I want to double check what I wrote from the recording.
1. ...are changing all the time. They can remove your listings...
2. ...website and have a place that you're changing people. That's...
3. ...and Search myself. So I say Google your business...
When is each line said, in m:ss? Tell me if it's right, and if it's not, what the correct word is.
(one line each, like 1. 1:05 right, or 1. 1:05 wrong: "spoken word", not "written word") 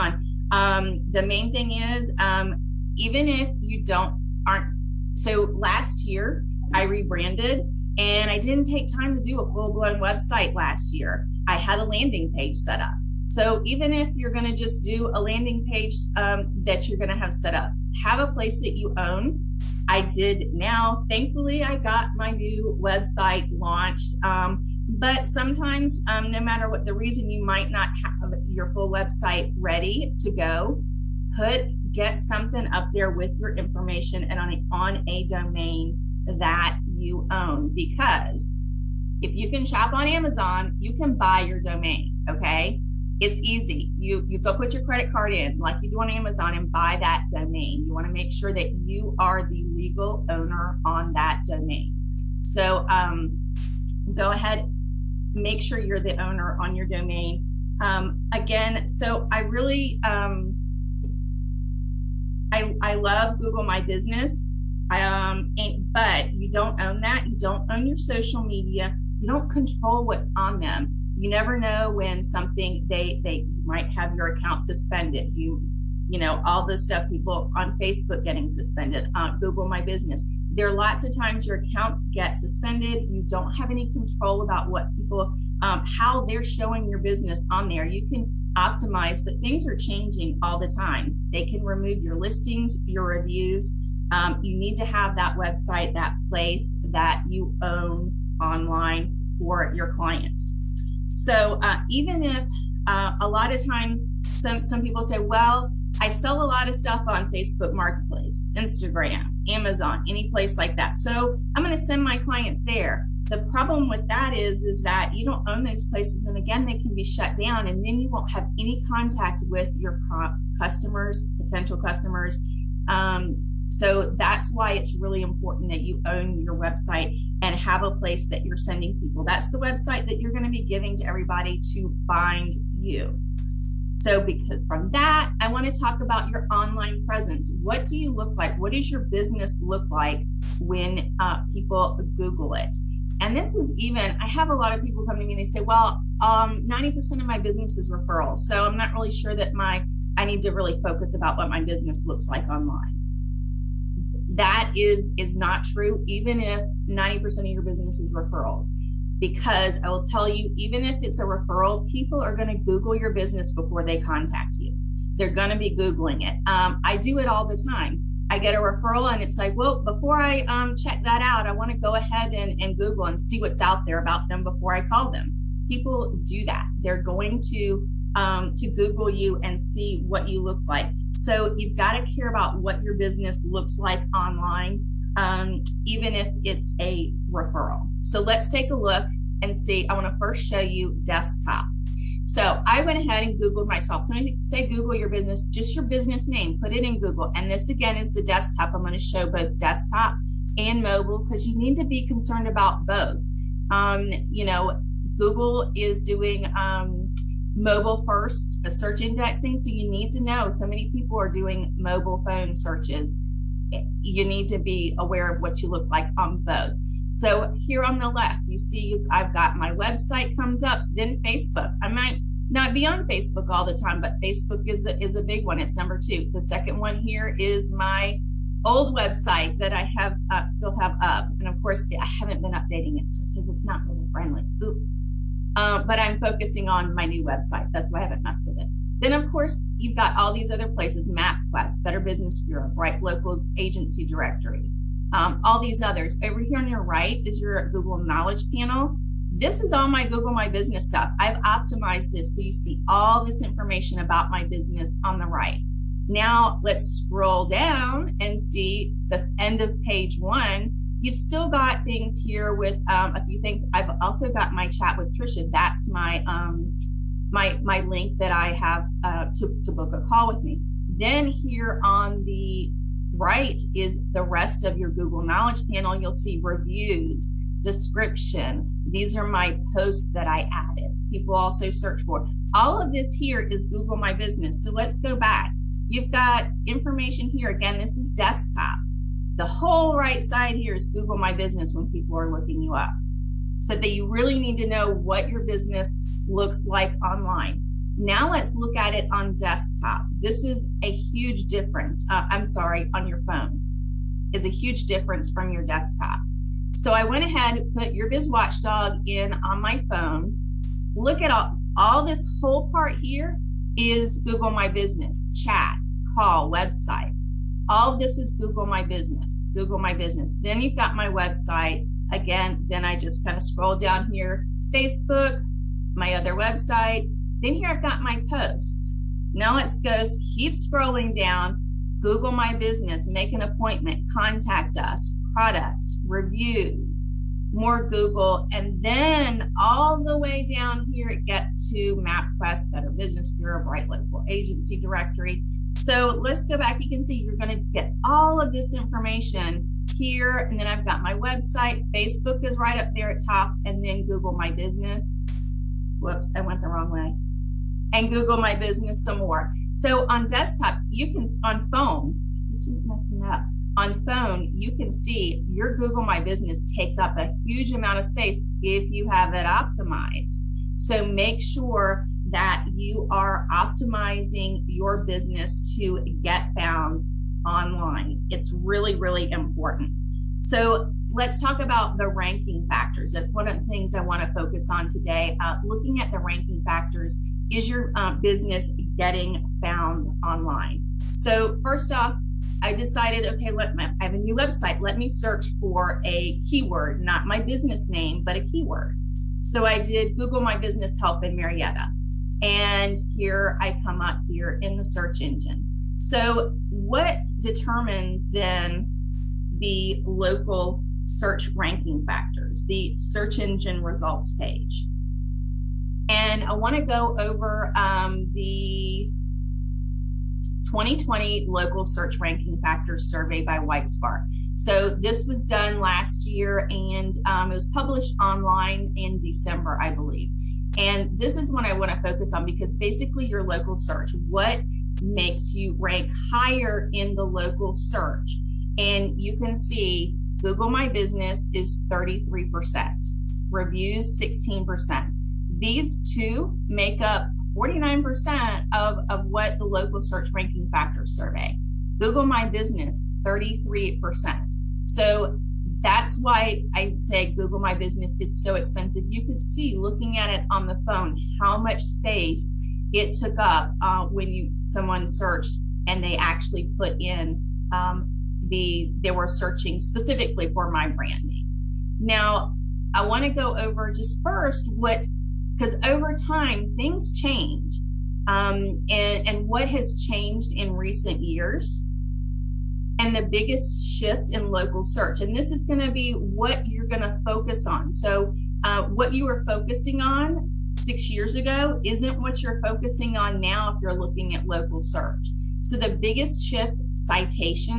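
1. 1:29 right
2. 2:06 wrong: "sending", not "changing"
3. 3:13 wrong: "Googled", not "Search".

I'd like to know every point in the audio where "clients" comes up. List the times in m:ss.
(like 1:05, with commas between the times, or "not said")
1:39, 1:52.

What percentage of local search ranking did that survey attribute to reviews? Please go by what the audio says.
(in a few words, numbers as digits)
16%.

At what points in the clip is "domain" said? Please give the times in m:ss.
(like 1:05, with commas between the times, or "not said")
0:35, 0:41, 0:47, 0:51, 0:56.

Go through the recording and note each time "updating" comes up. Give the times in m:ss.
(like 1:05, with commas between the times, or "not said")
3:52.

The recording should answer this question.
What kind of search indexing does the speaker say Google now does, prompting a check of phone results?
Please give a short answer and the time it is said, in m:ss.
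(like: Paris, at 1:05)
mobile first search indexing, at 3:27.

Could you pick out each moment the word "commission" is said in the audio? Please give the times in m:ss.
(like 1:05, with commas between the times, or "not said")
not said.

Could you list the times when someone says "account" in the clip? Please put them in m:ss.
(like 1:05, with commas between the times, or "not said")
1:14, 1:21.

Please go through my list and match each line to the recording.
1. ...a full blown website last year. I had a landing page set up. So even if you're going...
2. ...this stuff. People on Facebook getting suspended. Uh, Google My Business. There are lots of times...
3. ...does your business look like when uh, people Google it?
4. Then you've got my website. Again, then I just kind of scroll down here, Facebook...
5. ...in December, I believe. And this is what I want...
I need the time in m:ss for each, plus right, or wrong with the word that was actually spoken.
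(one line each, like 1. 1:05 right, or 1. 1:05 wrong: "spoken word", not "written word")
1. 0:09 right
2. 1:16 right
3. 2:18 right
4. 5:20 right
5. 7:08 right.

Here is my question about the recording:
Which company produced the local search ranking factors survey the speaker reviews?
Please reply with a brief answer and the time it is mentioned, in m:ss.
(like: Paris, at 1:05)
WhiteSpark, at 7:03.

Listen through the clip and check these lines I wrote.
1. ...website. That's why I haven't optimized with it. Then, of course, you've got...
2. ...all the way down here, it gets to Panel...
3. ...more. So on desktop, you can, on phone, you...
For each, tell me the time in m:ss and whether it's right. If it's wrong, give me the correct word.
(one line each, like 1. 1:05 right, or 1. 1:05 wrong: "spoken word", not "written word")
1. 3:57 wrong: "messed", not "optimized"
2. 5:39 wrong: "MapQuest", not "Panel"
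3. 5:59 right.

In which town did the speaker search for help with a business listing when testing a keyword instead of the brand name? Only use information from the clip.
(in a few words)
Marietta.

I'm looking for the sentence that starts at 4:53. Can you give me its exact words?
So that you really need to know what your business looks like online.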